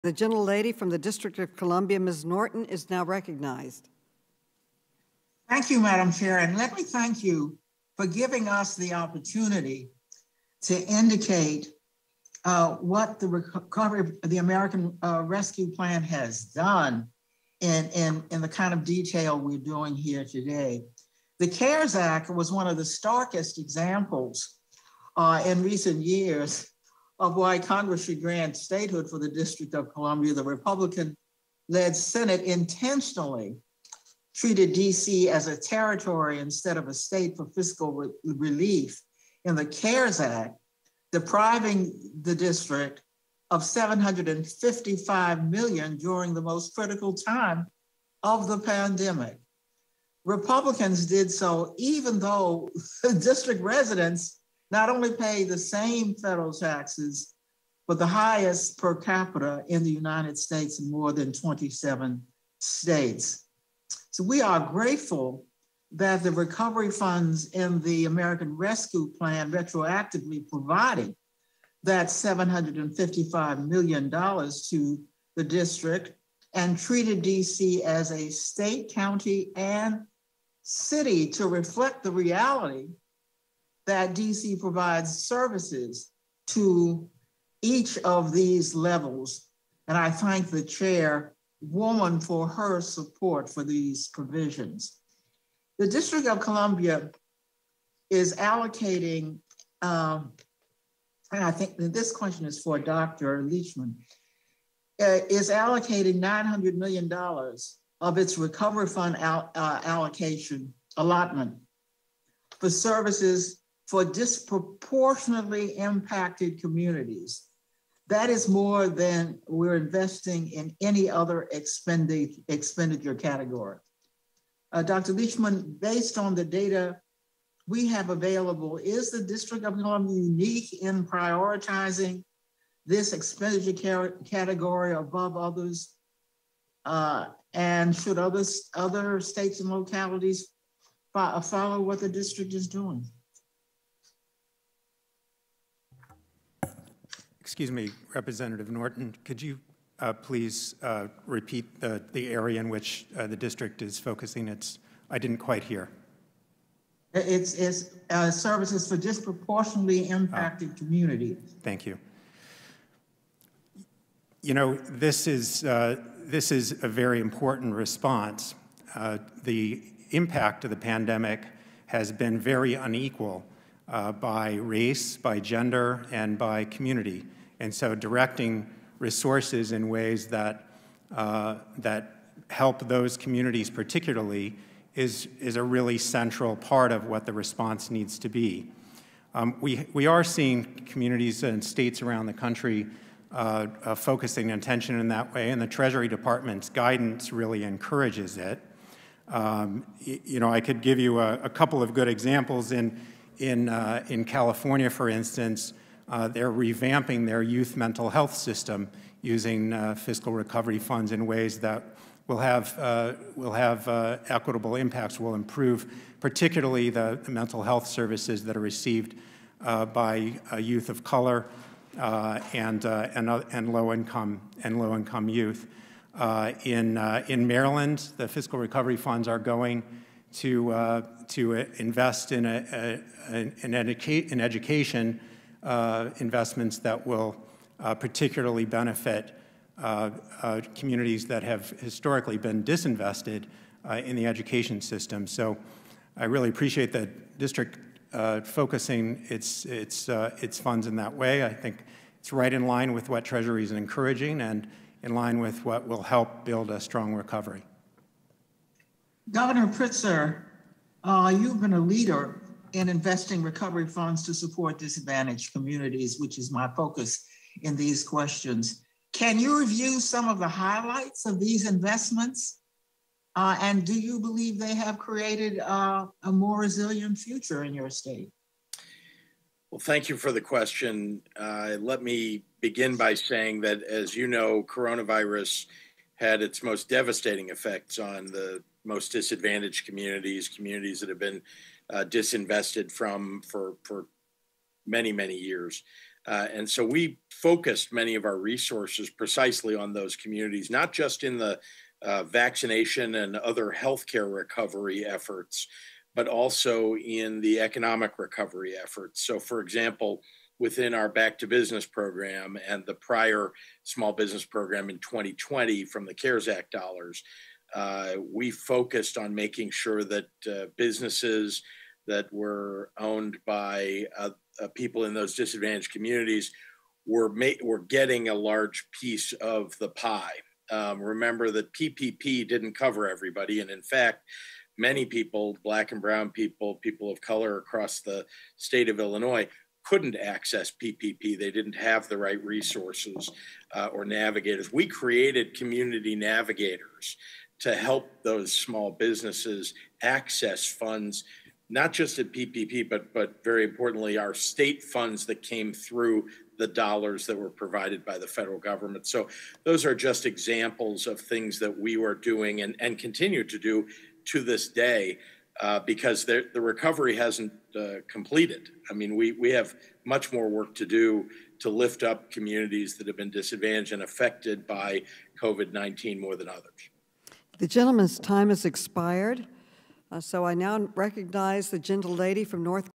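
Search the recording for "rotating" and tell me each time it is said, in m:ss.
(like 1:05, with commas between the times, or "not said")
not said.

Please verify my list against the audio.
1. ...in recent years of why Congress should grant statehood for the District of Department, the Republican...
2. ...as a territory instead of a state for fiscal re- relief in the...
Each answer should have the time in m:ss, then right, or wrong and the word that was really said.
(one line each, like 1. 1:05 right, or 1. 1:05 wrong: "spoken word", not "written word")
1. 0:25 wrong: "Columbia", not "Department"
2. 0:35 right.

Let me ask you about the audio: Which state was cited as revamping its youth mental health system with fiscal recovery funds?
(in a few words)
California.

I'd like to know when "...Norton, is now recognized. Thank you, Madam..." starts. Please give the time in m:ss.
0:02.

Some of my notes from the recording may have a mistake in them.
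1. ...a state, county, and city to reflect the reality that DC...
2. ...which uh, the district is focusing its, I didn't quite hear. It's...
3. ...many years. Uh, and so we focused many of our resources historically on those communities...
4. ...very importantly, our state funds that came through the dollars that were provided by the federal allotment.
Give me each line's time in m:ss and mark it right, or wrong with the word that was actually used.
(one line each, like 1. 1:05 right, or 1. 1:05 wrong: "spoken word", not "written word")
1. 1:18 right
2. 2:32 right
3. 4:55 wrong: "precisely", not "historically"
4. 5:53 wrong: "government", not "allotment".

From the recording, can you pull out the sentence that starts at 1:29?
And I thank the chair woman for her support for these provisions.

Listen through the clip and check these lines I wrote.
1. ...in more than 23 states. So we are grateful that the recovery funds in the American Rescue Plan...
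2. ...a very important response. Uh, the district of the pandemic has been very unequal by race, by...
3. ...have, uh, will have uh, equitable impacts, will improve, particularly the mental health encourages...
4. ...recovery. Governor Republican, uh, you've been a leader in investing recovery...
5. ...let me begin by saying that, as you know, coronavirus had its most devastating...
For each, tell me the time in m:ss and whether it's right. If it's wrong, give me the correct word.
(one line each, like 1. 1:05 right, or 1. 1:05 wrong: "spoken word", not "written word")
1. 1:00 wrong: "27", not "23"
2. 2:46 wrong: "impact", not "district"
3. 3:32 wrong: "services", not "encourages"
4. 4:17 wrong: "Pritzker", not "Republican"
5. 4:41 right.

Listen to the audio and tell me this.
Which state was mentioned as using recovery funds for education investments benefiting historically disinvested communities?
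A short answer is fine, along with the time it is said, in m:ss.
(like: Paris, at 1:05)
Maryland, at 3:47.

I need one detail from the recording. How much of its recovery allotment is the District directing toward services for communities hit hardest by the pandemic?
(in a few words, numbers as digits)
$900 million.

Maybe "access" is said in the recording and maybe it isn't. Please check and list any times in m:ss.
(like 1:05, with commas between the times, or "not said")
5:40, 5:50.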